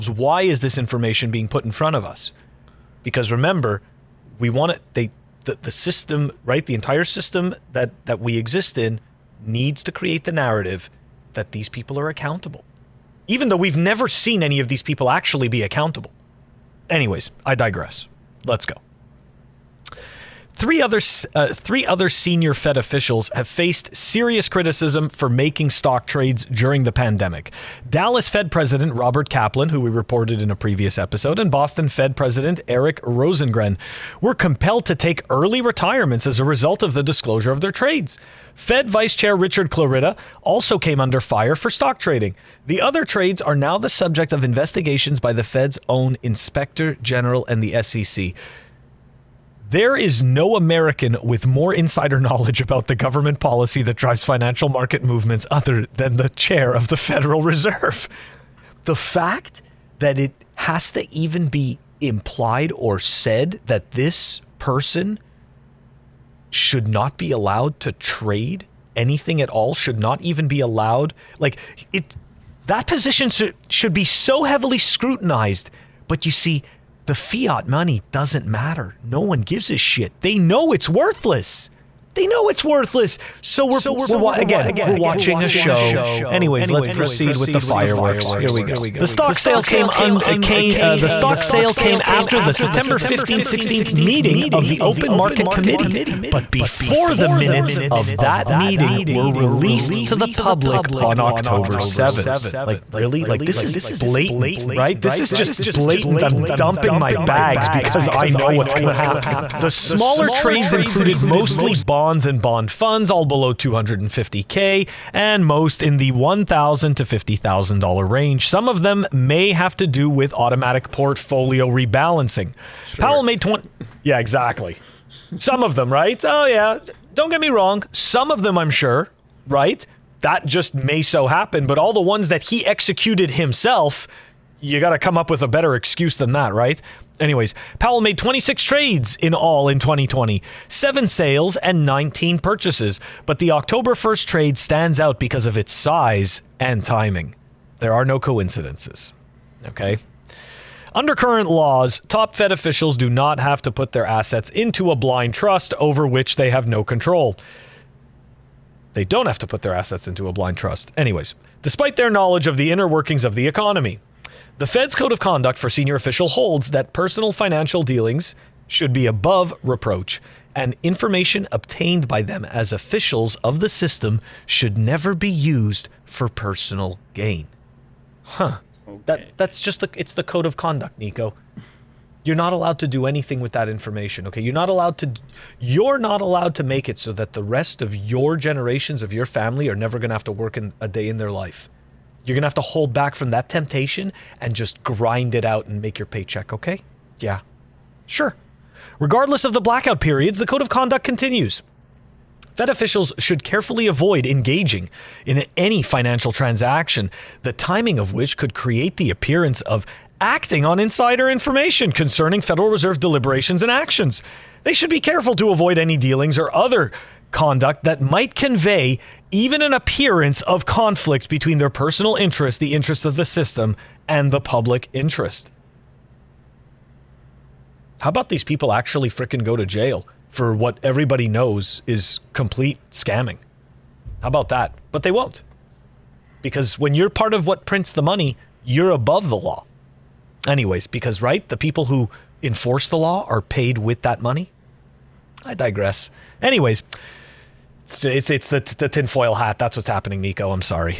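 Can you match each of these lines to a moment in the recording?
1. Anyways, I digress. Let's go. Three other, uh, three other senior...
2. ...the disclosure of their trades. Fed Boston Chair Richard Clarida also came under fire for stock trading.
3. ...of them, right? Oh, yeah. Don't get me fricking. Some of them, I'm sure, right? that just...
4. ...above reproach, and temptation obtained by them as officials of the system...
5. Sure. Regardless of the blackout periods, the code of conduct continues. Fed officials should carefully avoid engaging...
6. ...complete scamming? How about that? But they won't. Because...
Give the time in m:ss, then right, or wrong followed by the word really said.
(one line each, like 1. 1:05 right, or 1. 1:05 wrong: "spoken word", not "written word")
1. 0:16 right
2. 0:36 wrong: "Vice", not "Boston"
3. 2:05 wrong: "wrong", not "fricking"
4. 2:49 wrong: "information", not "temptation"
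5. 3:18 right
6. 3:52 right.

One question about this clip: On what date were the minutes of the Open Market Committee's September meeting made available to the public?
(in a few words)
October 7.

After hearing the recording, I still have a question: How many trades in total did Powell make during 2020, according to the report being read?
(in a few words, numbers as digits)
26.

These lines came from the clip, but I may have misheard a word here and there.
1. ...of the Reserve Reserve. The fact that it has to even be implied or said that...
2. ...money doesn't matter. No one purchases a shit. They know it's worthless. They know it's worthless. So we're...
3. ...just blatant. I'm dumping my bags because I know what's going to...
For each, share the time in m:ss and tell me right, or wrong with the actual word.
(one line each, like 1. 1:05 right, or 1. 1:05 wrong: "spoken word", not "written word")
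1. 0:56 wrong: "Federal", not "Reserve"
2. 1:17 wrong: "gives", not "purchases"
3. 1:45 right.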